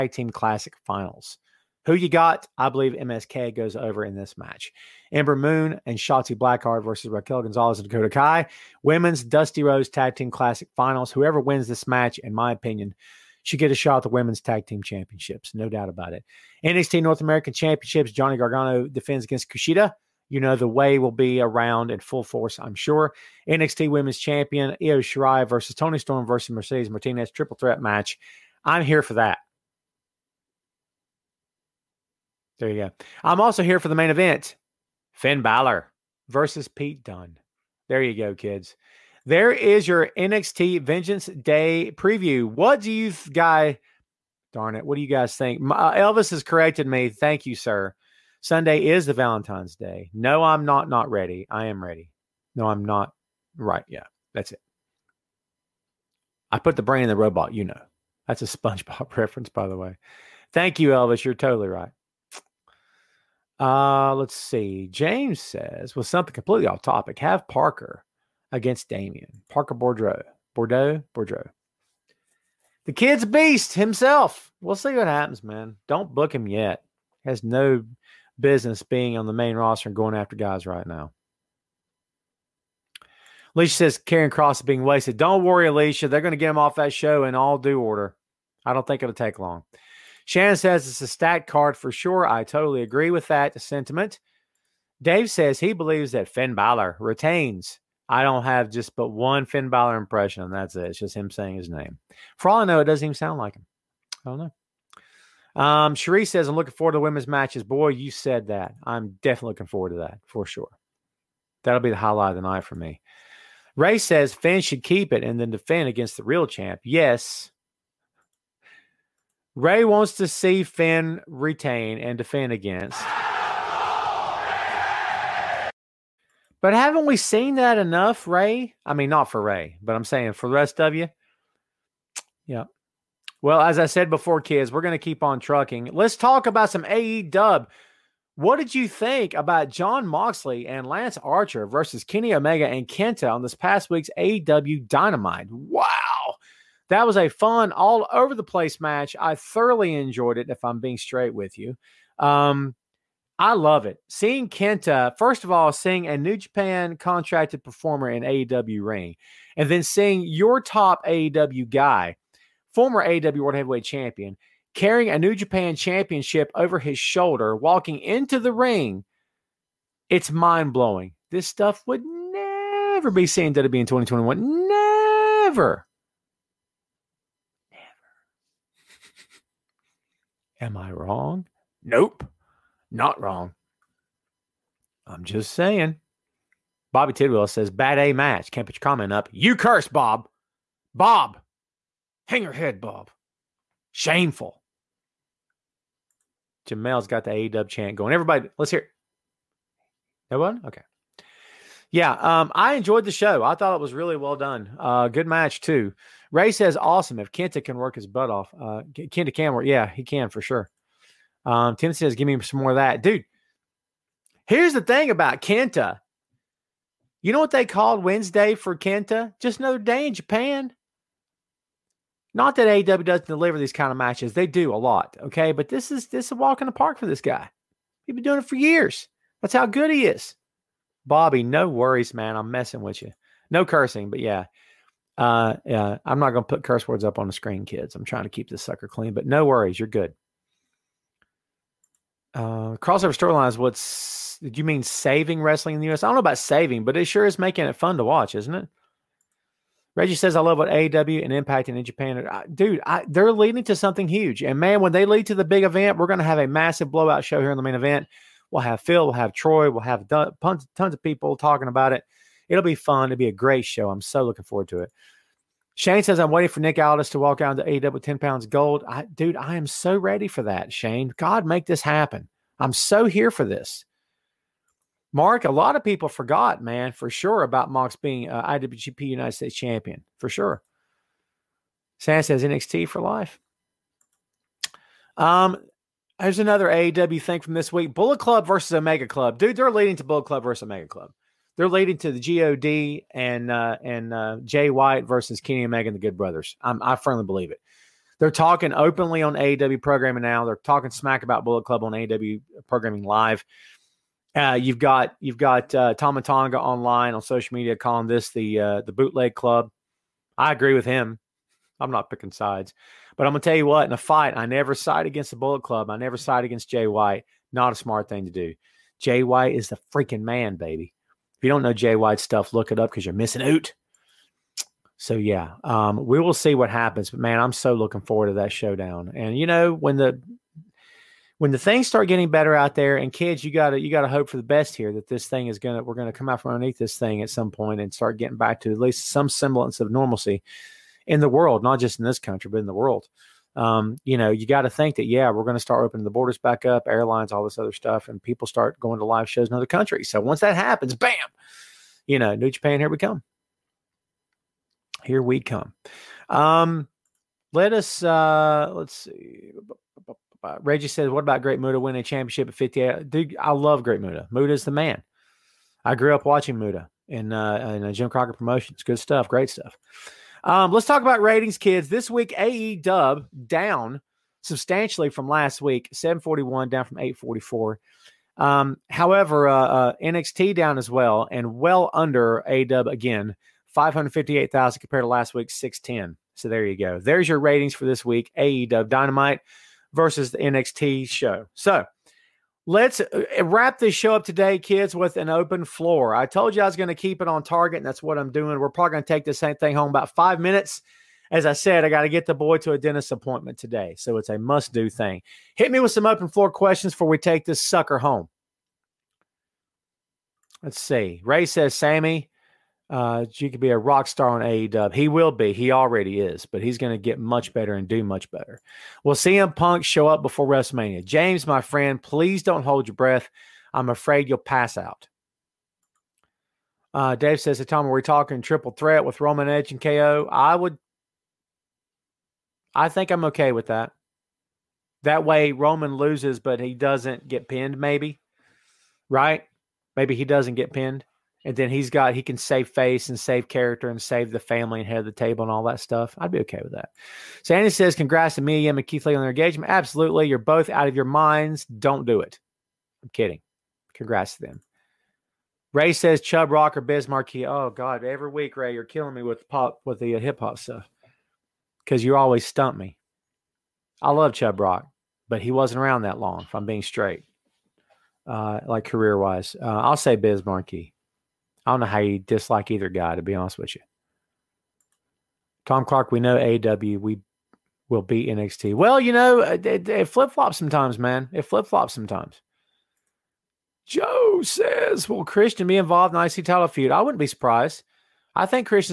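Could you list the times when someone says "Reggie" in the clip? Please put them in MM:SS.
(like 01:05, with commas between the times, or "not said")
04:09, 06:00.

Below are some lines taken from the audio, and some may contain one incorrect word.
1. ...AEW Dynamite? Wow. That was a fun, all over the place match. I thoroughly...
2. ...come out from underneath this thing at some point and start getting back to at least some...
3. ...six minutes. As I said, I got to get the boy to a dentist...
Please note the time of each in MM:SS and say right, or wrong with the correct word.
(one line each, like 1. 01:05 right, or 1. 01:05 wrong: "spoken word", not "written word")
1. 02:24 right
2. 05:36 right
3. 06:40 wrong: "five", not "six".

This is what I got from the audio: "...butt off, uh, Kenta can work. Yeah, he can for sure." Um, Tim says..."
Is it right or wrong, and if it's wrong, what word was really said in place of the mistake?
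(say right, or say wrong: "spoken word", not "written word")
right.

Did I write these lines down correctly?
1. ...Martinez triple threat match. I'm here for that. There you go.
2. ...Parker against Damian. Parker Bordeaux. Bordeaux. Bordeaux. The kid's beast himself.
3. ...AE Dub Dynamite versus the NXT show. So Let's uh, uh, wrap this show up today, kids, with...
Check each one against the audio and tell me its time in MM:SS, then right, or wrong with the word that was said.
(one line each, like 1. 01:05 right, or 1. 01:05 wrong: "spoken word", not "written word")
1. 00:26 right
2. 01:07 right
3. 06:28 right.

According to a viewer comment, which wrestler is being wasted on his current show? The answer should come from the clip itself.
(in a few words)
Karrion Kross.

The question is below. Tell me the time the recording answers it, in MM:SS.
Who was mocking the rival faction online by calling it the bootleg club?
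05:05.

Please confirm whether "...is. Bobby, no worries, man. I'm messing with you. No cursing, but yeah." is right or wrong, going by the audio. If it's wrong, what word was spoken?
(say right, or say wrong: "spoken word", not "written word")
right.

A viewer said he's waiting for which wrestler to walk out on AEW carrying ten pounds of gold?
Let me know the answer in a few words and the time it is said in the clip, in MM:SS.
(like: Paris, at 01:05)
Nick Aldis, at 04:26.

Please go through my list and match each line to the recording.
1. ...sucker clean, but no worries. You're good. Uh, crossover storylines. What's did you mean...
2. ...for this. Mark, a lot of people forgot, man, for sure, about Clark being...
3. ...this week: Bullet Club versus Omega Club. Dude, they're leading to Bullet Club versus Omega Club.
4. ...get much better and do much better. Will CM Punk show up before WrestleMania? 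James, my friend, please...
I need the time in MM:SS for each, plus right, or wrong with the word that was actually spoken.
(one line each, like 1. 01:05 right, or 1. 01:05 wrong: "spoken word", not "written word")
1. 03:58 right
2. 04:33 wrong: "Mox", not "Clark"
3. 04:47 right
4. 06:56 right.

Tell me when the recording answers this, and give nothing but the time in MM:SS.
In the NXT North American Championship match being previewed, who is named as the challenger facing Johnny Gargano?
00:19.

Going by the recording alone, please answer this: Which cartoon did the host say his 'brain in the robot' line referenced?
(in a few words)
SpongeBob.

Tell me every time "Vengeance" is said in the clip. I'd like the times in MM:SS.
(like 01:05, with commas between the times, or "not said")
00:40.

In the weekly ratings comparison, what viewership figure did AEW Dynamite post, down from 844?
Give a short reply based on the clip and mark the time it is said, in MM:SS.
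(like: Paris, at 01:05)
741, at 06:15.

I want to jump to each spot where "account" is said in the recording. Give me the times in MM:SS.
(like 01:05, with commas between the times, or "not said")
not said.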